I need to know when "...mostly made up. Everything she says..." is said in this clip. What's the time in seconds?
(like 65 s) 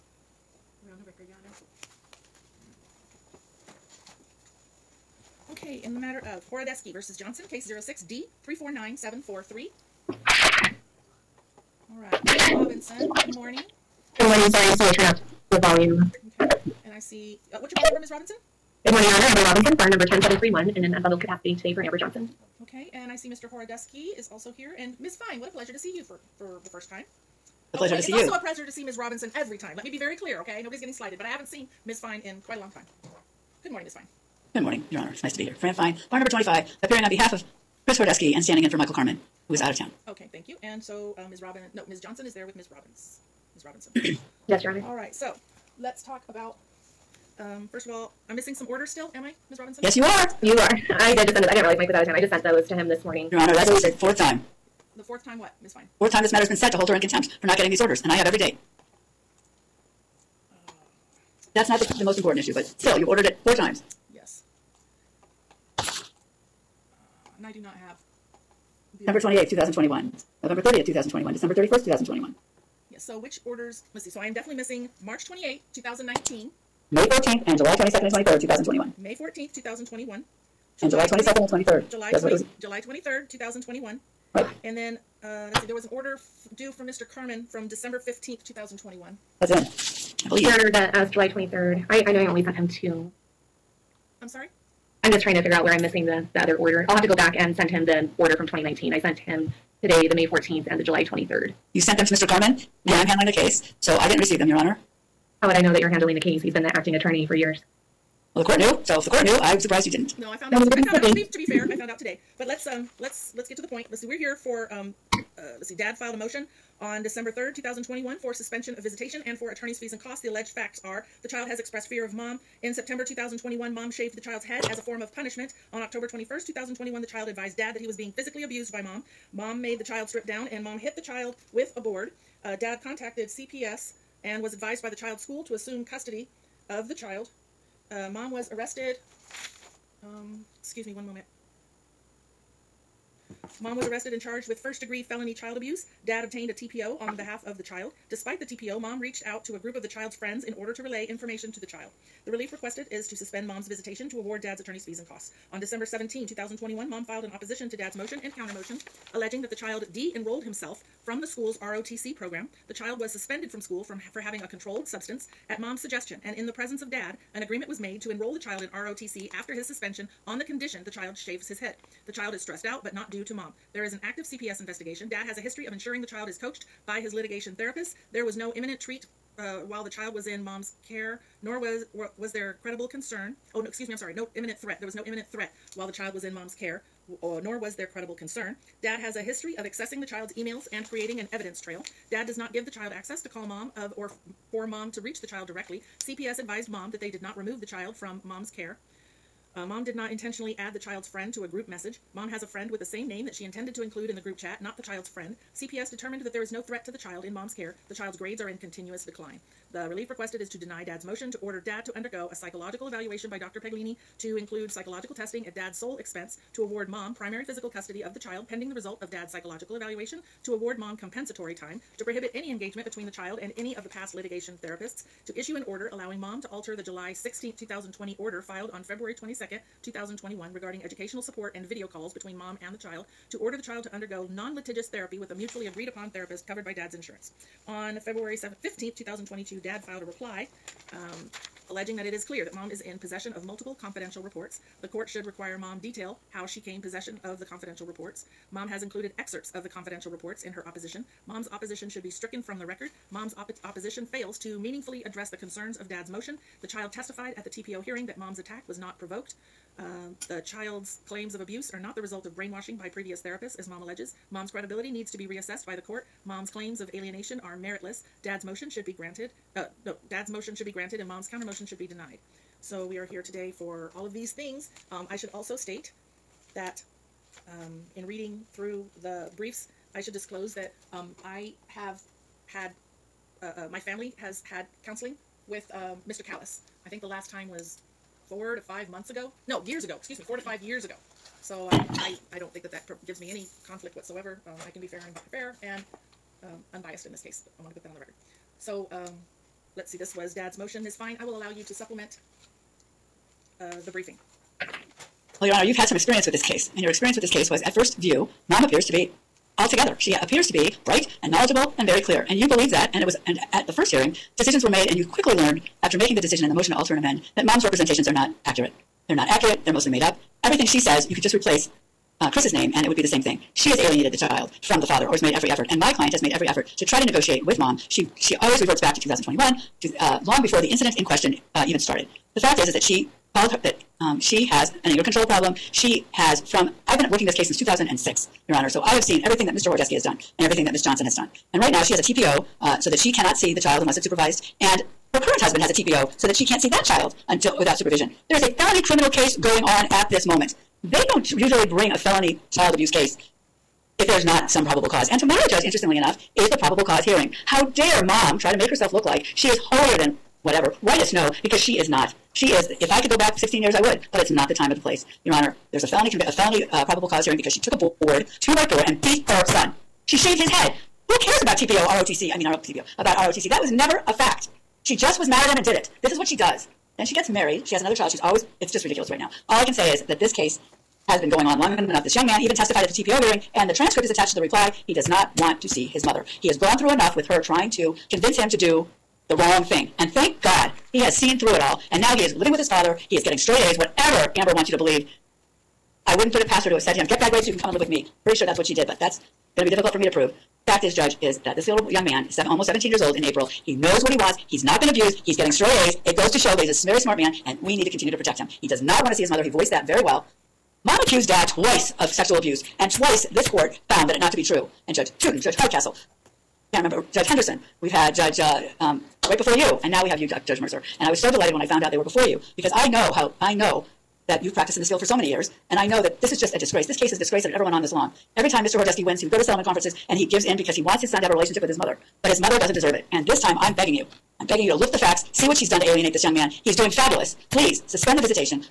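319 s.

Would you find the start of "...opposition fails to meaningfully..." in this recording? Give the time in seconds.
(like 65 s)
253 s.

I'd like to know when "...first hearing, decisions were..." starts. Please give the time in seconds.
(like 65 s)
313 s.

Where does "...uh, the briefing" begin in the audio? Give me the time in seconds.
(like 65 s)
303 s.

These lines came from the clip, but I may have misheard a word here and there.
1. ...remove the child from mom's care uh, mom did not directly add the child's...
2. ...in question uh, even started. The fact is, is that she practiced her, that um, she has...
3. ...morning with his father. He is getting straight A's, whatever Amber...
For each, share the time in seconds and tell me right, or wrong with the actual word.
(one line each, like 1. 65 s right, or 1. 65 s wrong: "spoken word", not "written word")
1. 197 s wrong: "intentionally", not "directly"
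2. 330 s wrong: "called", not "practiced"
3. 392 s wrong: "living", not "morning".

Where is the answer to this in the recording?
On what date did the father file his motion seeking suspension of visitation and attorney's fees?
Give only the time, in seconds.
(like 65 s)
117 s.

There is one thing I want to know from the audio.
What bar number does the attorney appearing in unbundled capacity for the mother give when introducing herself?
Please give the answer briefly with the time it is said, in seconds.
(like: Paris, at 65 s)
10731, at 20 s.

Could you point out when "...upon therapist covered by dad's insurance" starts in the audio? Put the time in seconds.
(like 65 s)
235 s.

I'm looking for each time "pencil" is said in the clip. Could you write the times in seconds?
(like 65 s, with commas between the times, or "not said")
not said.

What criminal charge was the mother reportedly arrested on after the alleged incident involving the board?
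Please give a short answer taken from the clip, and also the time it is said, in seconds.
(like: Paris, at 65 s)
first degree felony child abuse, at 144 s.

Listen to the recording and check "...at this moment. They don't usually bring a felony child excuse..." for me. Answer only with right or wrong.
wrong.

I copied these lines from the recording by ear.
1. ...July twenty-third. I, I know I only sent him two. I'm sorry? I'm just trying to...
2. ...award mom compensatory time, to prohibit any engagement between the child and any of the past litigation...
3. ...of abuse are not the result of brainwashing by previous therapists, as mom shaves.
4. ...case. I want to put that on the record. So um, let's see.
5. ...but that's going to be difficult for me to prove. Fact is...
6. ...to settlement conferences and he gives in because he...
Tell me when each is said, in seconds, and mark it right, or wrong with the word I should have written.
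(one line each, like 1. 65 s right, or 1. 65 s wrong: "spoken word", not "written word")
1. 91 s right
2. 220 s right
3. 261 s wrong: "alleges", not "shaves"
4. 297 s right
5. 398 s right
6. 429 s right.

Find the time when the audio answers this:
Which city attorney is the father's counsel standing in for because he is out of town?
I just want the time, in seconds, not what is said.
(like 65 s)
38 s.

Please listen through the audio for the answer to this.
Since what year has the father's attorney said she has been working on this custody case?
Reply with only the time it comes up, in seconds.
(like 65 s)
337 s.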